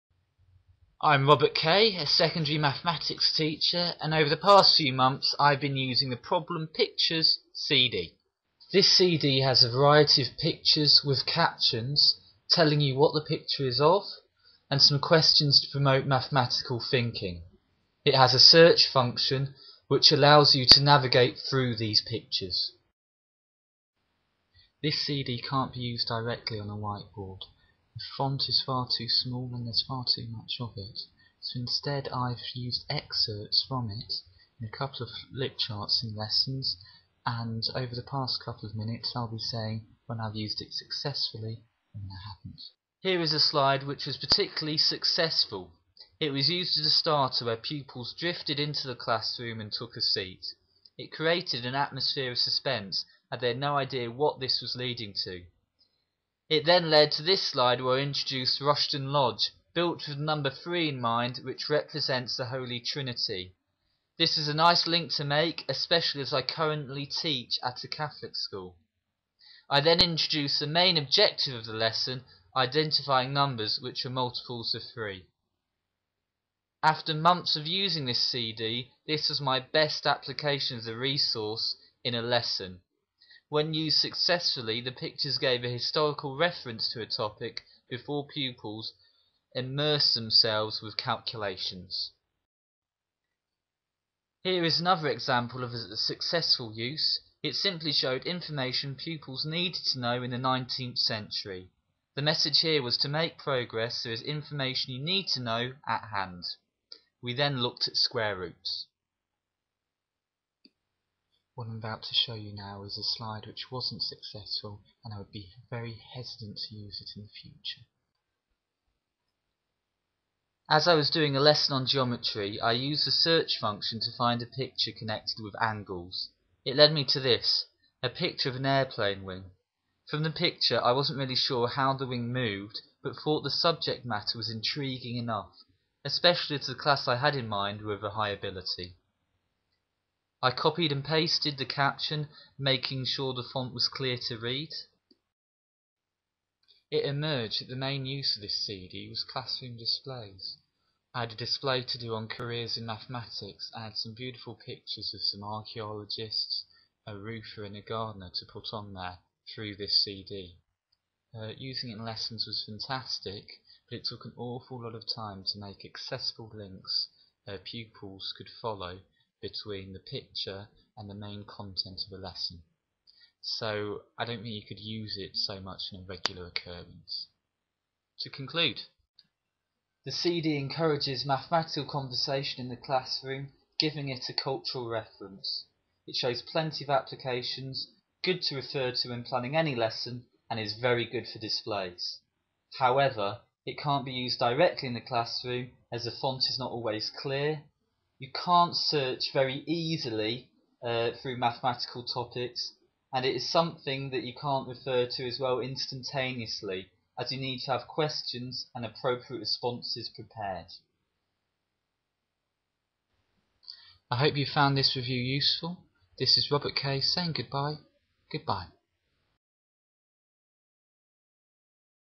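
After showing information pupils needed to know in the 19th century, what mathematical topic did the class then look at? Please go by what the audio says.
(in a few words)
square roots.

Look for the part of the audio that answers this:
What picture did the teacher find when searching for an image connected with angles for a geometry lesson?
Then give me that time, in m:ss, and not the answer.
2:08.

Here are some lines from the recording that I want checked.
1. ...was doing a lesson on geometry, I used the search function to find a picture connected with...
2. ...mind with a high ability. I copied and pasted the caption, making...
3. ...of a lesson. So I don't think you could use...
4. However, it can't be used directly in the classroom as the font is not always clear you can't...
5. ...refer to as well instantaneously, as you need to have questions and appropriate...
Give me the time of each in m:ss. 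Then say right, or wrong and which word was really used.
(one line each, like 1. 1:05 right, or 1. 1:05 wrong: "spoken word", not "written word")
1. 2:00 right
2. 2:17 right
3. 2:52 right
4. 3:12 right
5. 3:24 right.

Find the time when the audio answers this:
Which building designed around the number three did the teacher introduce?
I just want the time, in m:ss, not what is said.
0:58.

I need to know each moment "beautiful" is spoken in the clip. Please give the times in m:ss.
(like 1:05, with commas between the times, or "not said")
2:34.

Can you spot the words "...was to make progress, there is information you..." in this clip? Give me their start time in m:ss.
1:42.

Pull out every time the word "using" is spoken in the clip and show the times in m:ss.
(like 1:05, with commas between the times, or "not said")
0:05, 1:17, 2:41.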